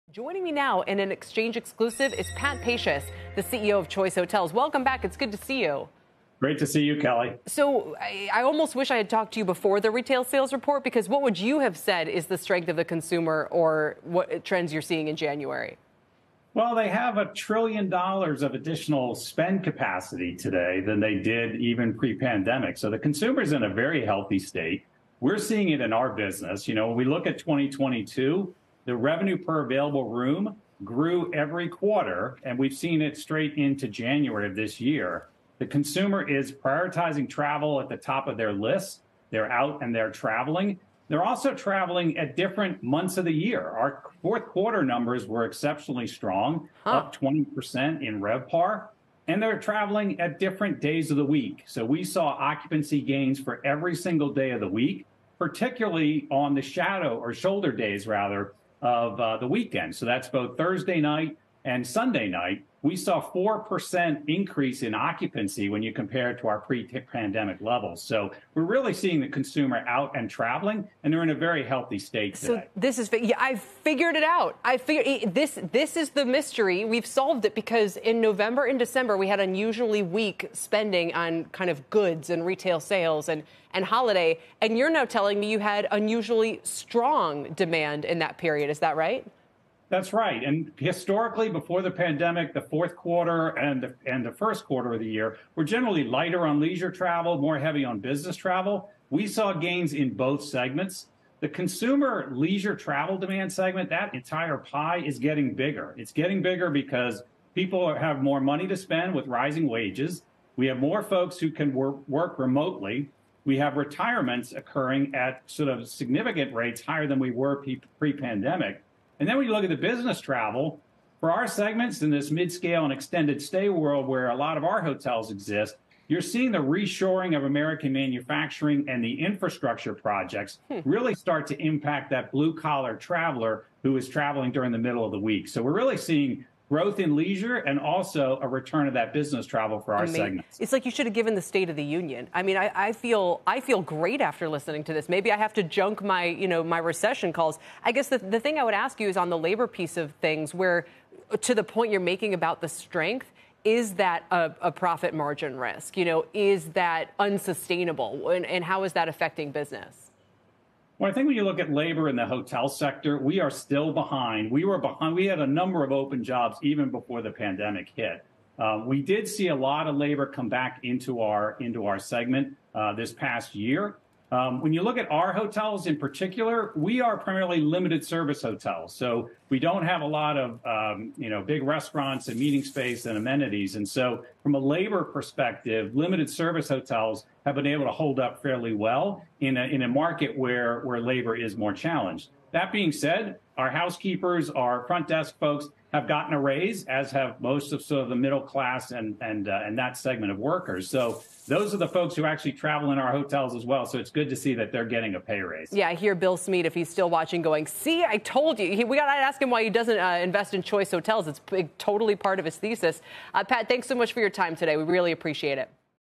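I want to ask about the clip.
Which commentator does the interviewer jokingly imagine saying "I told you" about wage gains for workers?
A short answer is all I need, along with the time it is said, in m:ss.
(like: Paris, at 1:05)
Bill Smead, at 3:26.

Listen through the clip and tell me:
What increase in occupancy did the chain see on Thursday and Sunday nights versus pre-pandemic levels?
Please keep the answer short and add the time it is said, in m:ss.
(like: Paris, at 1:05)
4%, at 1:03.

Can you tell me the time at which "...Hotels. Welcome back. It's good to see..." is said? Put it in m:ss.
0:04.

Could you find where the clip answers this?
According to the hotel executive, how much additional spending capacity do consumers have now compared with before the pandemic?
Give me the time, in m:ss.
0:17.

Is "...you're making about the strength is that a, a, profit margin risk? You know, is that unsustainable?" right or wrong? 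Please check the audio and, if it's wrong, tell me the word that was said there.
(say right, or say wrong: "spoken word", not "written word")
right.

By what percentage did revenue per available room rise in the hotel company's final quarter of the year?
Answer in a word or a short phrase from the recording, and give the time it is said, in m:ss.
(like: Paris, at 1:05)
20%, at 0:47.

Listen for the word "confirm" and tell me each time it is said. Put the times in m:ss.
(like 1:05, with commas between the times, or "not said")
not said.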